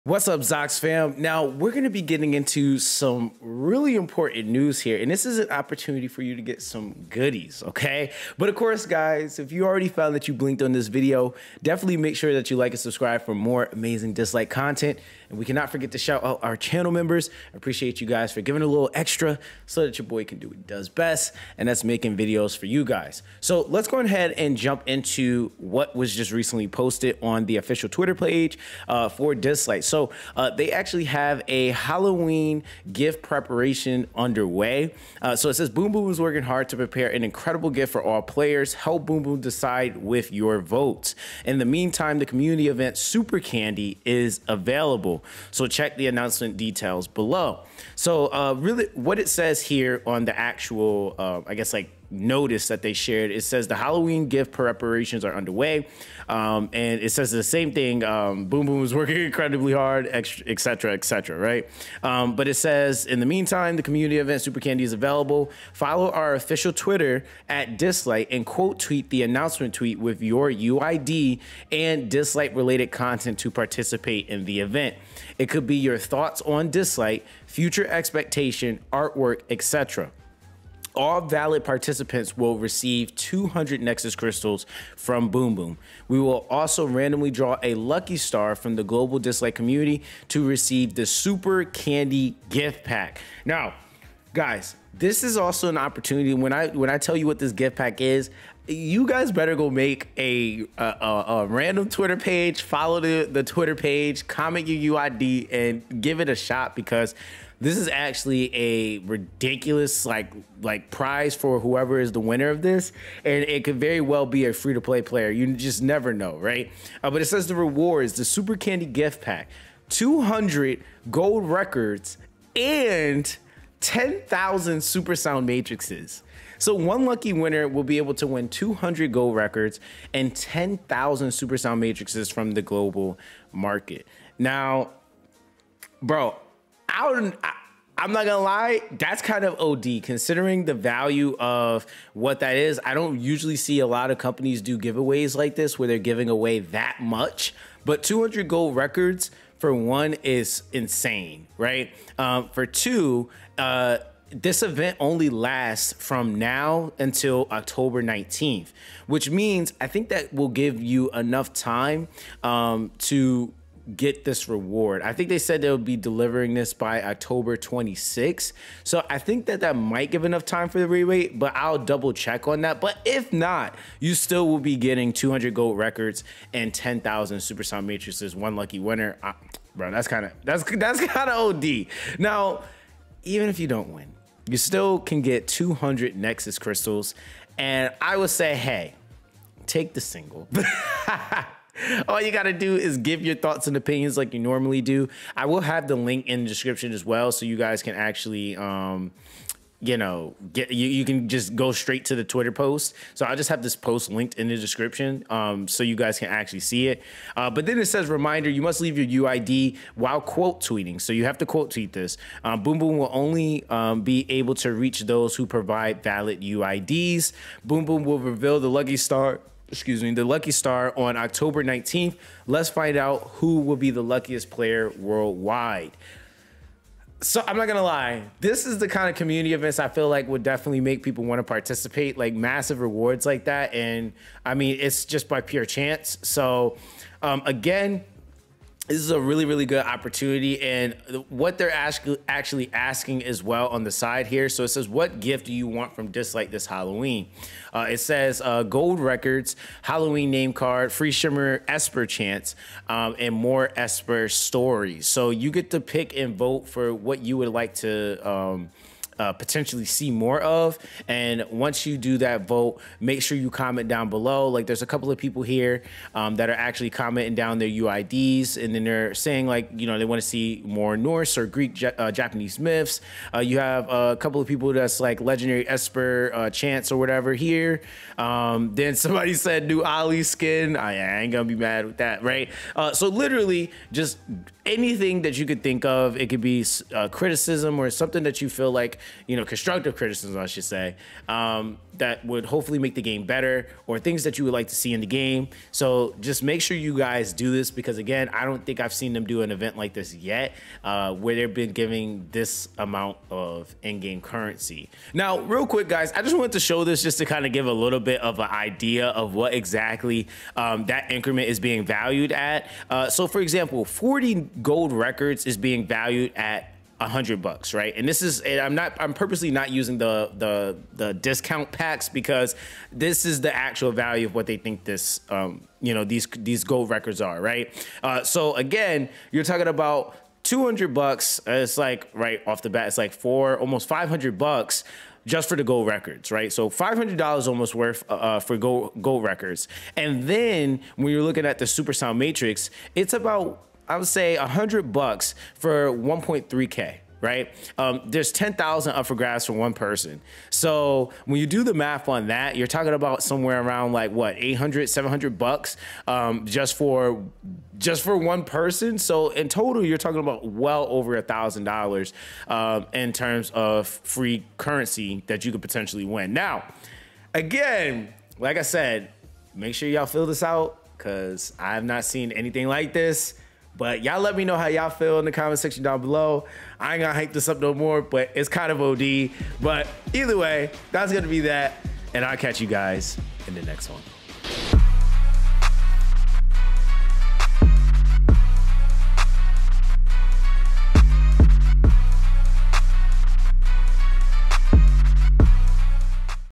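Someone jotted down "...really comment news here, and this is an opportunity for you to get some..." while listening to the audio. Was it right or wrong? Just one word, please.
wrong.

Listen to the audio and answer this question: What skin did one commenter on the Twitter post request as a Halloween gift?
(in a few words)
new Ollie skin.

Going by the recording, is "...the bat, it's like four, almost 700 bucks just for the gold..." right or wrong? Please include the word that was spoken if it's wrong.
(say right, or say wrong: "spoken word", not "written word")
wrong: "500", not "700".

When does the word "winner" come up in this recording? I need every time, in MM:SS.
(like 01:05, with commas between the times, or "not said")
01:52, 02:07, 02:58.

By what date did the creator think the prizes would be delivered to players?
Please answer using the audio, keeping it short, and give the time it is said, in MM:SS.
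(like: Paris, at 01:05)
October 26, at 02:47.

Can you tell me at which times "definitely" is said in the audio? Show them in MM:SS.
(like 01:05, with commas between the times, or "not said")
00:11, 03:50.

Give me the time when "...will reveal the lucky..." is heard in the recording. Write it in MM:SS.
03:38.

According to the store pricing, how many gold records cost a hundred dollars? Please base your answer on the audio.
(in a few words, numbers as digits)
40.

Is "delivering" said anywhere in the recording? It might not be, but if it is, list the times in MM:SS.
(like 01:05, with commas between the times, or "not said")
02:45.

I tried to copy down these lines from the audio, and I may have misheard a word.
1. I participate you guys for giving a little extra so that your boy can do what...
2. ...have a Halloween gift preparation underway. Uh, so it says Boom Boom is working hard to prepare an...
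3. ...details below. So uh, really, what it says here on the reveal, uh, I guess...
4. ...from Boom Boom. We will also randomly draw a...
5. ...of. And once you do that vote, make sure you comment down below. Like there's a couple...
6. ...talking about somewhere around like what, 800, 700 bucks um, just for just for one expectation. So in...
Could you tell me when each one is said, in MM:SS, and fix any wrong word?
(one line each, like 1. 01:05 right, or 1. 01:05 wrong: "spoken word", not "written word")
1. 00:17 wrong: "appreciate", not "participate"
2. 00:31 right
3. 00:46 wrong: "actual", not "reveal"
4. 01:24 right
5. 04:20 right
6. 05:52 wrong: "person", not "expectation".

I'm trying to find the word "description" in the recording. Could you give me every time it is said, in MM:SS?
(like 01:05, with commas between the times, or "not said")
03:16, 03:24.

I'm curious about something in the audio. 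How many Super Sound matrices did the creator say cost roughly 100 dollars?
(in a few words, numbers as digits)
1.3K.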